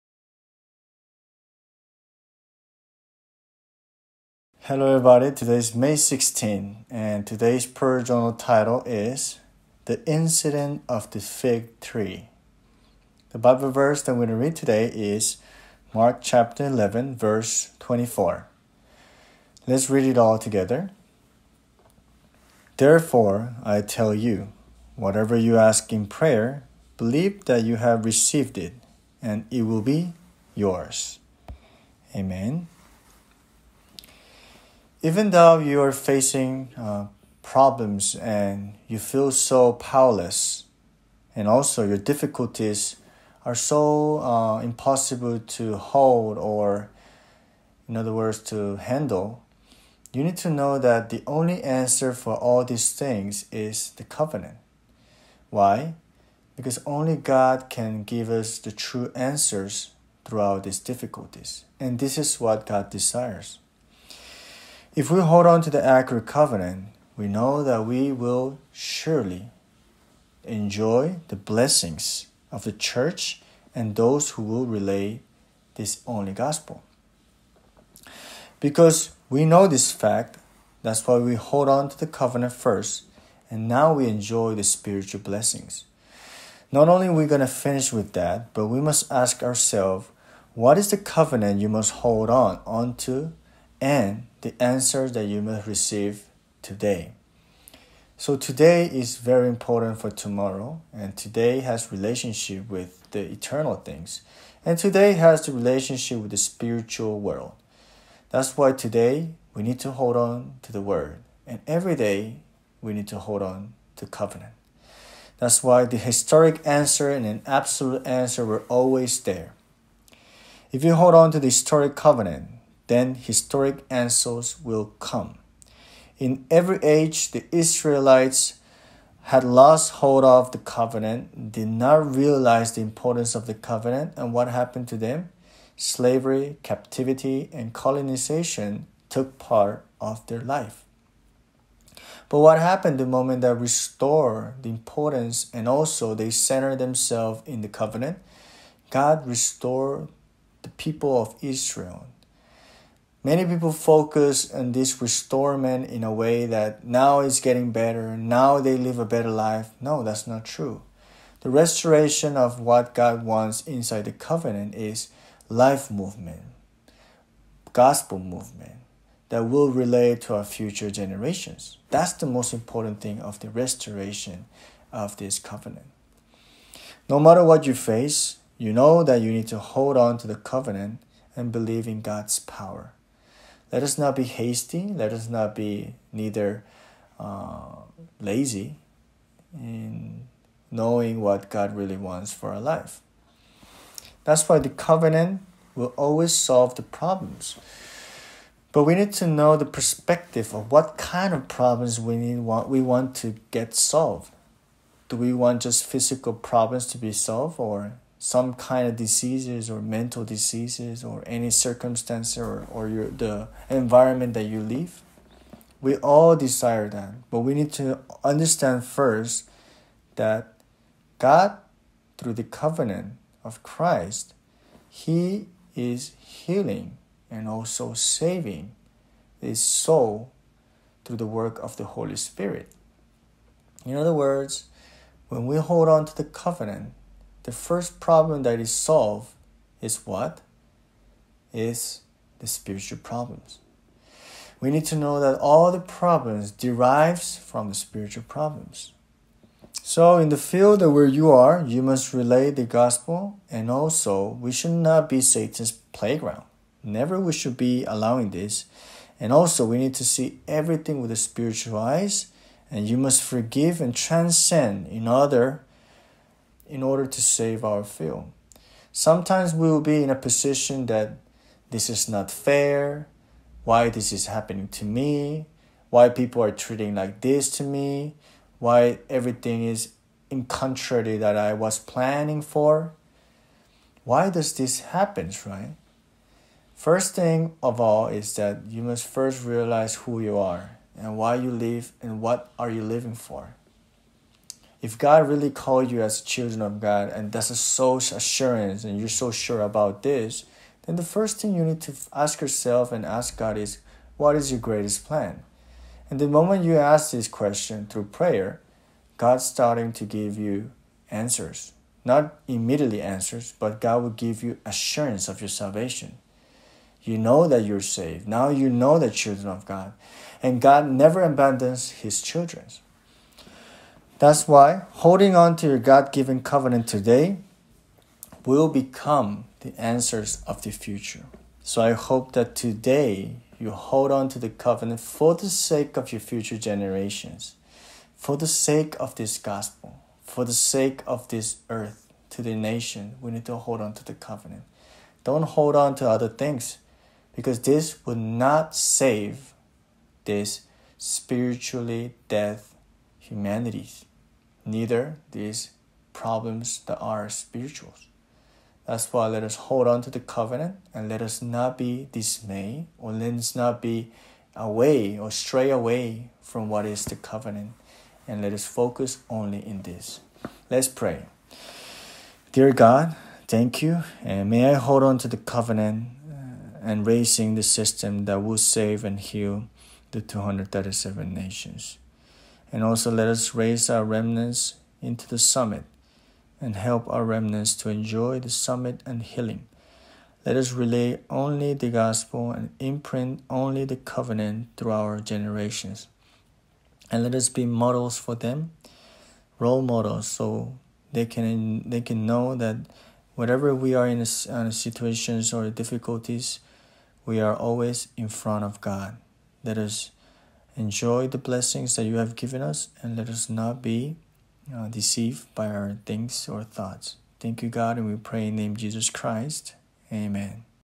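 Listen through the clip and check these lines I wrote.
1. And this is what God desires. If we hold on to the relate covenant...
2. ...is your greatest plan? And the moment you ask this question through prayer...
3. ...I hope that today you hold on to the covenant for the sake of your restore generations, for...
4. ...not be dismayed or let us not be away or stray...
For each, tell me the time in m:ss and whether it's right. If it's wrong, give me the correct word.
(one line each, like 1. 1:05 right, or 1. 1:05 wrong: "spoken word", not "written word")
1. 1:01 wrong: "accurate", not "relate"
2. 5:04 right
3. 5:31 wrong: "future", not "restore"
4. 6:01 right.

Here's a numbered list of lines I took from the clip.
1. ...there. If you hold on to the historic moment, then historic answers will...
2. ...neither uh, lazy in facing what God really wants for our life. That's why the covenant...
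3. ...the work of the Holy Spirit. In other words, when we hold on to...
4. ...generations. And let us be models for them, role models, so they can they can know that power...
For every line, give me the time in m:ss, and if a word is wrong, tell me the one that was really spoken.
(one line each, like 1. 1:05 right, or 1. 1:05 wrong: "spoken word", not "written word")
1. 1:59 wrong: "covenant", not "moment"
2. 3:06 wrong: "knowing", not "facing"
3. 3:51 right
4. 6:35 wrong: "whatever", not "power".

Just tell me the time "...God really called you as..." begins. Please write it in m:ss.
4:54.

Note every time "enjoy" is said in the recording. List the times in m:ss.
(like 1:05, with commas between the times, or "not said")
1:10, 1:24, 6:27, 6:50.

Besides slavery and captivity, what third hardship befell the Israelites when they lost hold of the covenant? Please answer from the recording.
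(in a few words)
Colonization.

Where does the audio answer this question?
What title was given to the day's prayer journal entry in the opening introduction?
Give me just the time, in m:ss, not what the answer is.
0:09.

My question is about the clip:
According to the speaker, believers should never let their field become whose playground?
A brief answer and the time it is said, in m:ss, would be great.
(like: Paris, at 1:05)
Satan's, at 4:15.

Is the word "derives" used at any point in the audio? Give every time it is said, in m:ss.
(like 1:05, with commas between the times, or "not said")
4:06.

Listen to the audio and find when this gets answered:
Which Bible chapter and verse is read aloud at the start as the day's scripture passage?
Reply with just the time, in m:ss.
0:15.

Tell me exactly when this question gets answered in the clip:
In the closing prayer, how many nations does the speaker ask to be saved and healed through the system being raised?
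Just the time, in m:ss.
6:20.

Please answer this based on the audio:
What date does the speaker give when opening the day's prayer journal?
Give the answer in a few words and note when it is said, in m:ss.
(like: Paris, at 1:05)
May 16, at 0:05.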